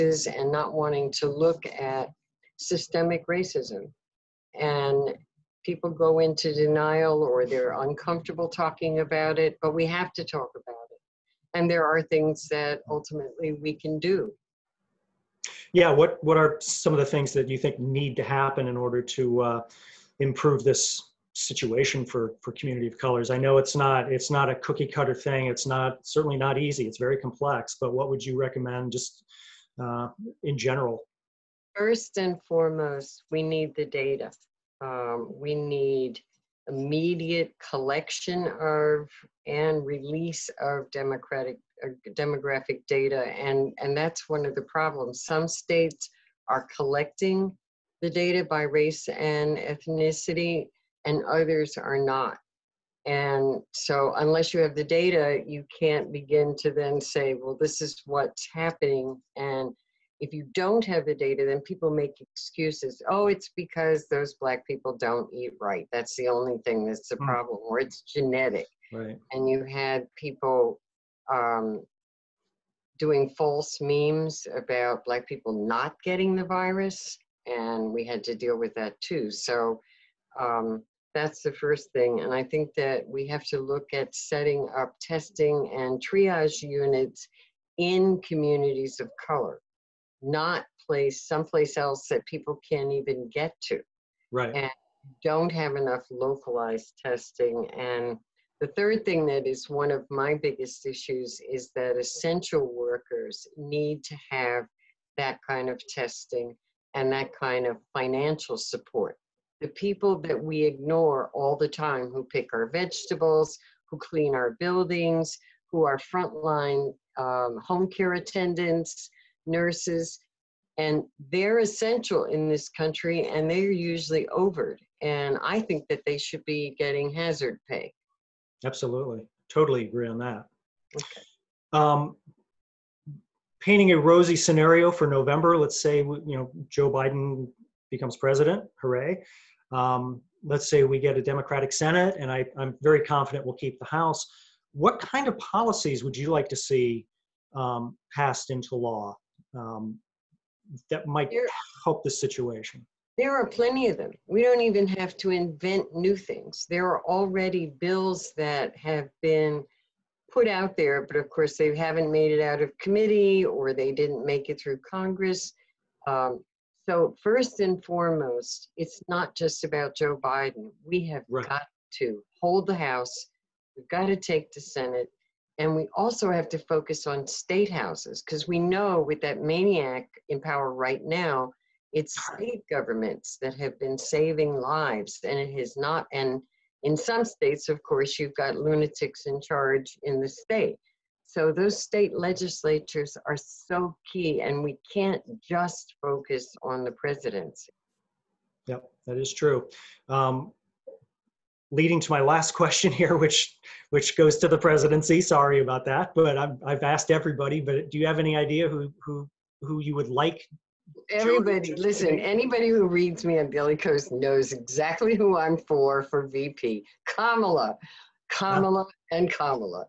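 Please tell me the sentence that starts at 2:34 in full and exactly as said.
We don't even have to invent new things.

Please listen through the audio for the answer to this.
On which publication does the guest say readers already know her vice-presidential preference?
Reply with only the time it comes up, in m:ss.
3:33.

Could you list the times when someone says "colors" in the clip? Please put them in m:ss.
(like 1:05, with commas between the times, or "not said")
0:22, 1:29.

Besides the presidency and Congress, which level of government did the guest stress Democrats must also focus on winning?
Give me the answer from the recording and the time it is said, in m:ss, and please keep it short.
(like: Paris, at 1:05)
State houses, at 2:57.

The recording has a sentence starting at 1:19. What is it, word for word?
So um, that's the first thing.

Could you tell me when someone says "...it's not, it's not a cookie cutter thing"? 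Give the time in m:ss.
0:23.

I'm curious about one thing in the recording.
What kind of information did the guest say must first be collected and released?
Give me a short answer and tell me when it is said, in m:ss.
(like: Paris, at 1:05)
Demographic data, at 0:42.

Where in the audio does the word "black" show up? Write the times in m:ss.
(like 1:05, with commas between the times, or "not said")
1:04, 1:15.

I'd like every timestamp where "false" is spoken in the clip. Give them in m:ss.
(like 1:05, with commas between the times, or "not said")
1:13.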